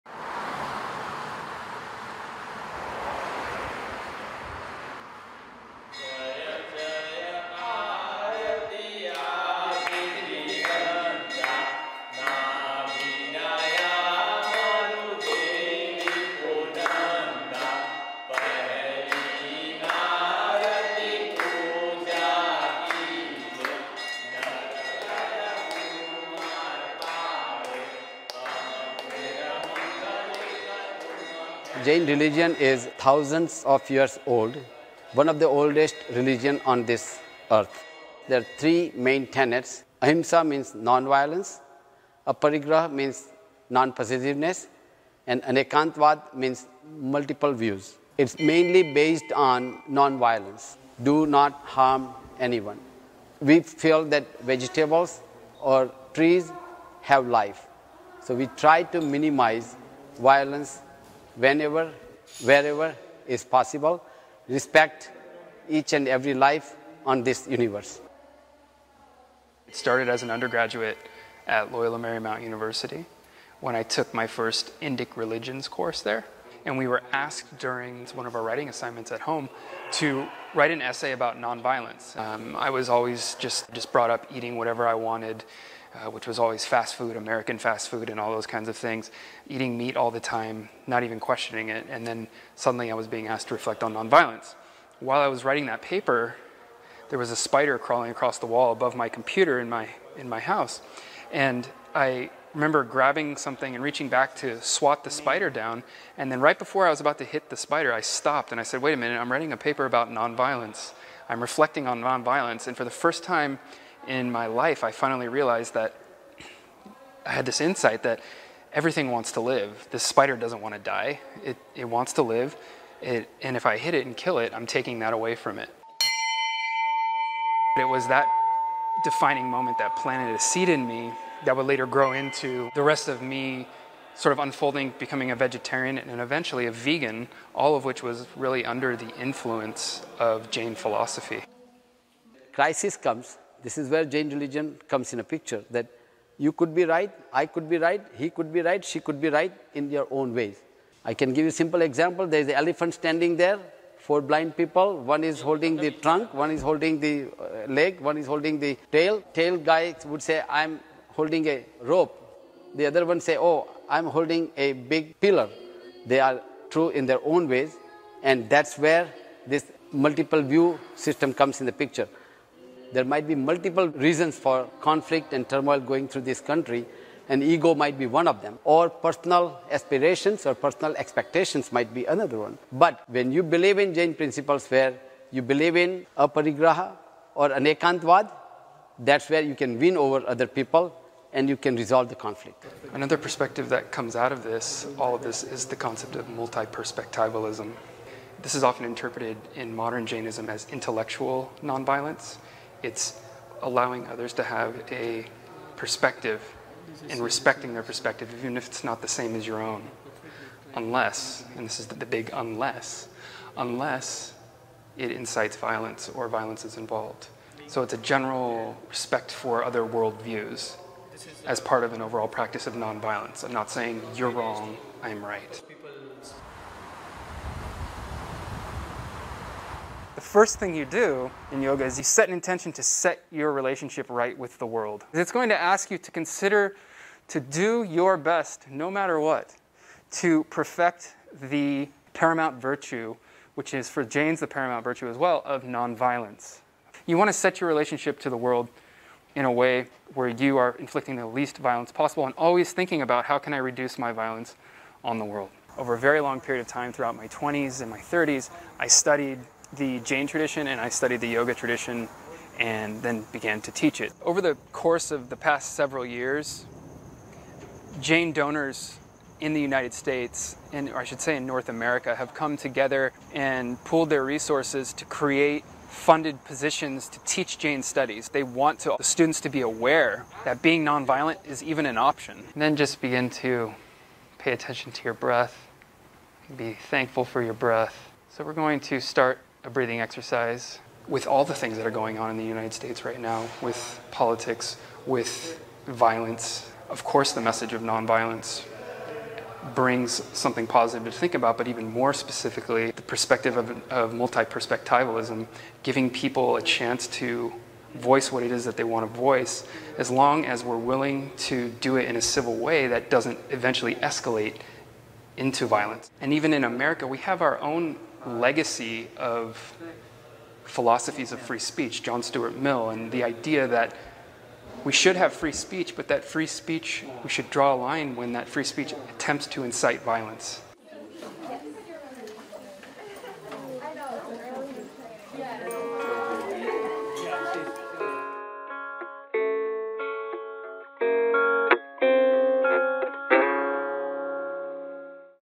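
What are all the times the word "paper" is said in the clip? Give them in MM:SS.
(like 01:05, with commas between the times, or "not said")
01:35, 01:49.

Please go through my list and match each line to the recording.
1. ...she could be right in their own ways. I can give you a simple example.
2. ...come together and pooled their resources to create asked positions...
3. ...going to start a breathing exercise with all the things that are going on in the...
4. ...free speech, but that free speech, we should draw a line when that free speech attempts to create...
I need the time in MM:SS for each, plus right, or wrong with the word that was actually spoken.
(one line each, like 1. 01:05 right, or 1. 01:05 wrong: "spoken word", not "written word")
1. 02:28 right
2. 04:32 wrong: "funded", not "asked"
3. 04:48 right
4. 05:25 wrong: "incite", not "create".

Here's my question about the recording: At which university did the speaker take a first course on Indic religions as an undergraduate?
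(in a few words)
Loyola Marymount University.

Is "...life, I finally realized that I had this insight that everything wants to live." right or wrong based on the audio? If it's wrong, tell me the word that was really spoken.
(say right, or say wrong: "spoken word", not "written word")
right.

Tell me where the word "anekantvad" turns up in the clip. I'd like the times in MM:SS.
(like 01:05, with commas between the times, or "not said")
00:45, 03:07.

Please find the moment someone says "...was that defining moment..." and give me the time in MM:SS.
02:07.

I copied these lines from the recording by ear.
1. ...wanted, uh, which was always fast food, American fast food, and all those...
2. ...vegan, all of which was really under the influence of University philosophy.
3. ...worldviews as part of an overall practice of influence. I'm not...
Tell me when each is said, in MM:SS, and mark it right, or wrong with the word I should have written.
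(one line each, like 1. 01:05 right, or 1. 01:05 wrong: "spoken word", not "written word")
1. 01:24 right
2. 02:16 wrong: "Jain", not "University"
3. 03:39 wrong: "nonviolence", not "influence".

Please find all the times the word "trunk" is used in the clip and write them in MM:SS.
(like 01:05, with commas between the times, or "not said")
02:35.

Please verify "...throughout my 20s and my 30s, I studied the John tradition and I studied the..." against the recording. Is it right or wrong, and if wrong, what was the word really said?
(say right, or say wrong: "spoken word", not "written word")
wrong: "Jain", not "John".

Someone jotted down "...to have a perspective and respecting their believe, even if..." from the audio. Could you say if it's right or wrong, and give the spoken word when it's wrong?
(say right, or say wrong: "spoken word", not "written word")
wrong: "perspective", not "believe".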